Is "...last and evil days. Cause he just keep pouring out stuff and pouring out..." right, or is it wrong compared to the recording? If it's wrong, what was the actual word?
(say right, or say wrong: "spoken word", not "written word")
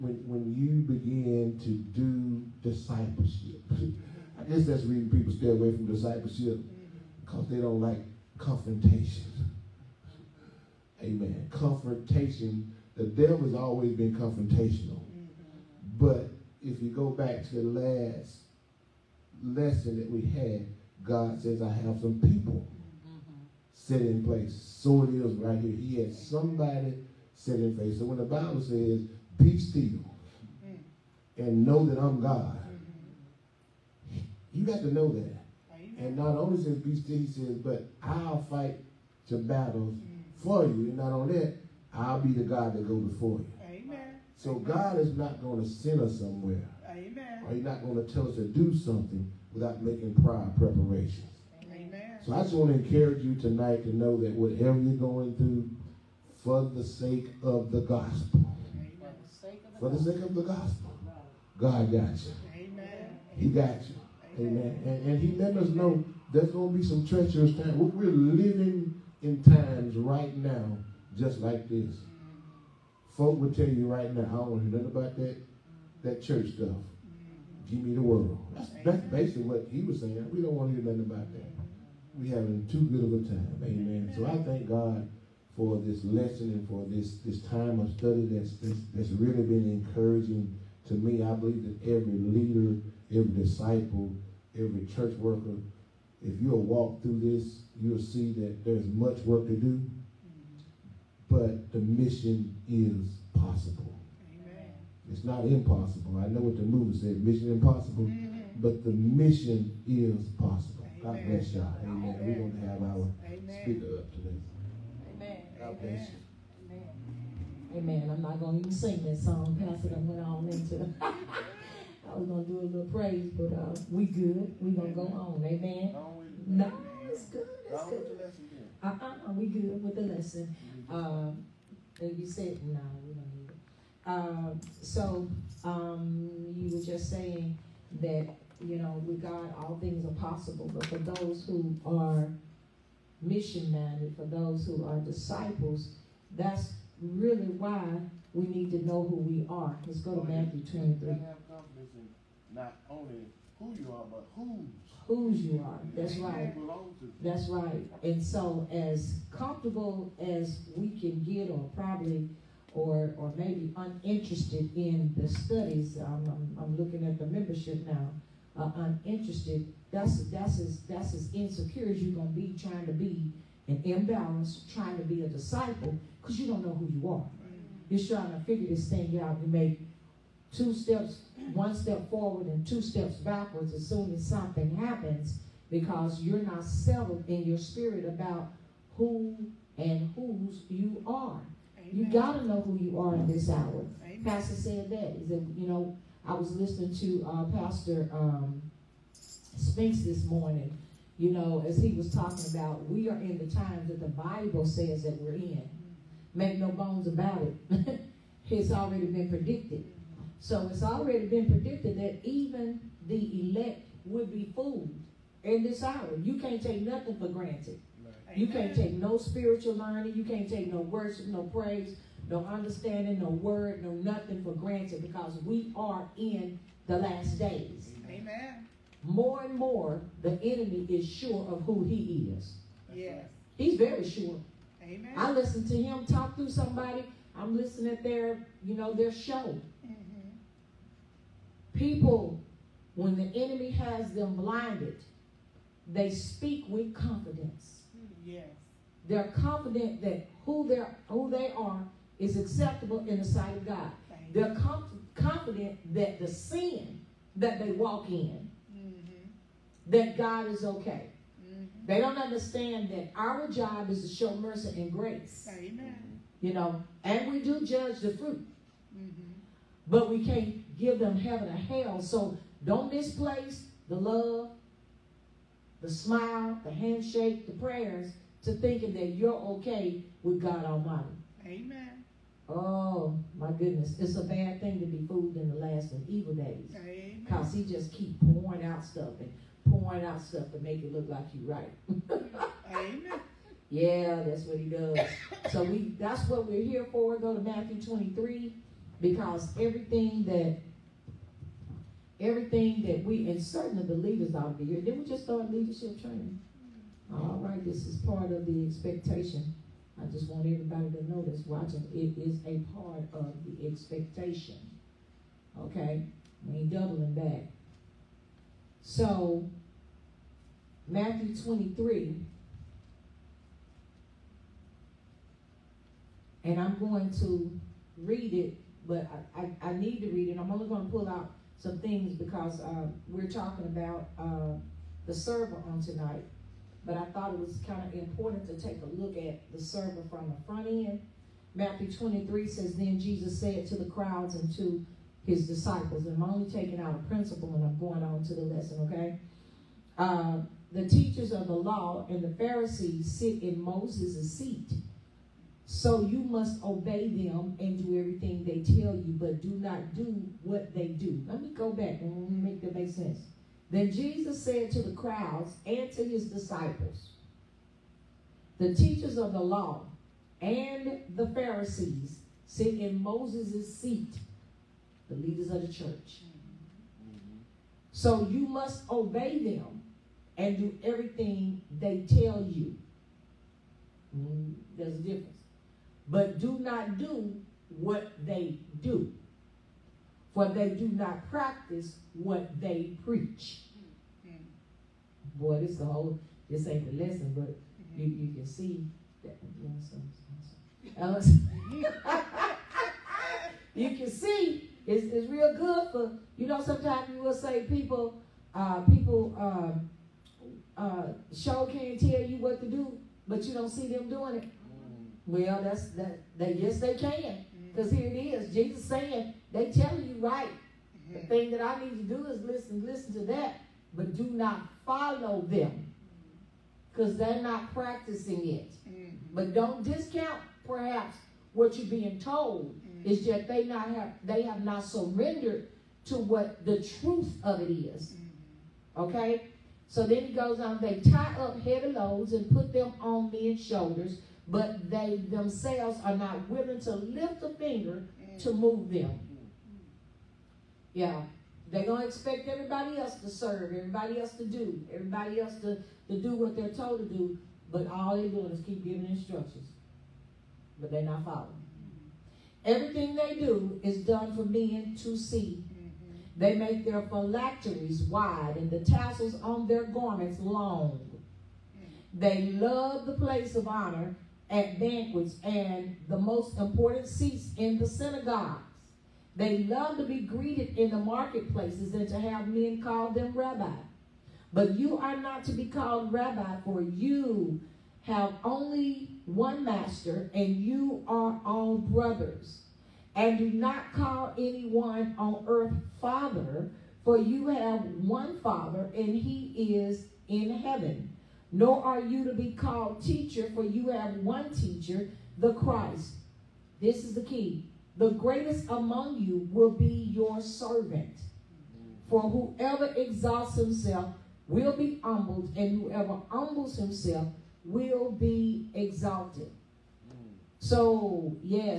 right.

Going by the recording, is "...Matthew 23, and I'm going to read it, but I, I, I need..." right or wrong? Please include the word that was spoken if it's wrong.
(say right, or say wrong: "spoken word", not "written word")
right.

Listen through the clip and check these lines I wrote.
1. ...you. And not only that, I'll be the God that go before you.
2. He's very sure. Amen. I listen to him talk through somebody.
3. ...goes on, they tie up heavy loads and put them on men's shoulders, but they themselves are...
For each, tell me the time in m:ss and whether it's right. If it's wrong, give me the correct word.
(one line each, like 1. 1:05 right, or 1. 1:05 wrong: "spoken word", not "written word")
1. 0:40 right
2. 3:53 right
3. 7:20 right.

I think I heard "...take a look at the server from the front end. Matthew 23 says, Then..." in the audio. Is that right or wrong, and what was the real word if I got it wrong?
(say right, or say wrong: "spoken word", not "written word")
right.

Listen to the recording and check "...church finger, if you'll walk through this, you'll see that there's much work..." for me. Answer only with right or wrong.
wrong.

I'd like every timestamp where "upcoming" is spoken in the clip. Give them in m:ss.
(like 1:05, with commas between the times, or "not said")
not said.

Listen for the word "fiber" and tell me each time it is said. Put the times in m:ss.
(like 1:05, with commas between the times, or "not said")
not said.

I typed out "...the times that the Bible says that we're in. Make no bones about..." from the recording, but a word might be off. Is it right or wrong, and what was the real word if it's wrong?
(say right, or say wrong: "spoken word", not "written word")
right.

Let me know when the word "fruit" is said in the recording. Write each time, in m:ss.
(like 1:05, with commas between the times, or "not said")
4:28.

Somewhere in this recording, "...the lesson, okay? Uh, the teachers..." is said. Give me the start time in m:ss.
5:48.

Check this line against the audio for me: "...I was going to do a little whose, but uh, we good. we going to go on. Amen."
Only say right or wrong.
wrong.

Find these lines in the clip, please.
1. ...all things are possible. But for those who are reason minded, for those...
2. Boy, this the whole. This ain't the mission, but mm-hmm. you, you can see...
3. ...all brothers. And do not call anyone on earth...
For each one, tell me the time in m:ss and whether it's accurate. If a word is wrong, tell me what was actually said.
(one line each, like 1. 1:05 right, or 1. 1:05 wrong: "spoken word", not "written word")
1. 2:19 wrong: "mission", not "reason"
2. 6:35 wrong: "lesson", not "mission"
3. 8:11 right.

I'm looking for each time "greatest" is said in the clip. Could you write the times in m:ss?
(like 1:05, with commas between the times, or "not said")
8:28.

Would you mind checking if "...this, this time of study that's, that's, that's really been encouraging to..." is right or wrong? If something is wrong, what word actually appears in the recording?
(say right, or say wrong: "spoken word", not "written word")
right.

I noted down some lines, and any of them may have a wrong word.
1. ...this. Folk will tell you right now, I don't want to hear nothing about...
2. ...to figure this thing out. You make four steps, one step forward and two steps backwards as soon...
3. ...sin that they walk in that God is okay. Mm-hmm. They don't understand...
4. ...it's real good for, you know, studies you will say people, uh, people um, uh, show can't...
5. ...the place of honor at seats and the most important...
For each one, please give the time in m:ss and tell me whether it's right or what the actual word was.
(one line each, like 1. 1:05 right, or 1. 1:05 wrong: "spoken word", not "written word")
1. 1:11 right
2. 2:58 wrong: "two", not "four"
3. 4:16 right
4. 6:45 wrong: "sometimes", not "studies"
5. 7:53 wrong: "banquets", not "seats".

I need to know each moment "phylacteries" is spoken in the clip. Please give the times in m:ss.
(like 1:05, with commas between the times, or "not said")
7:47.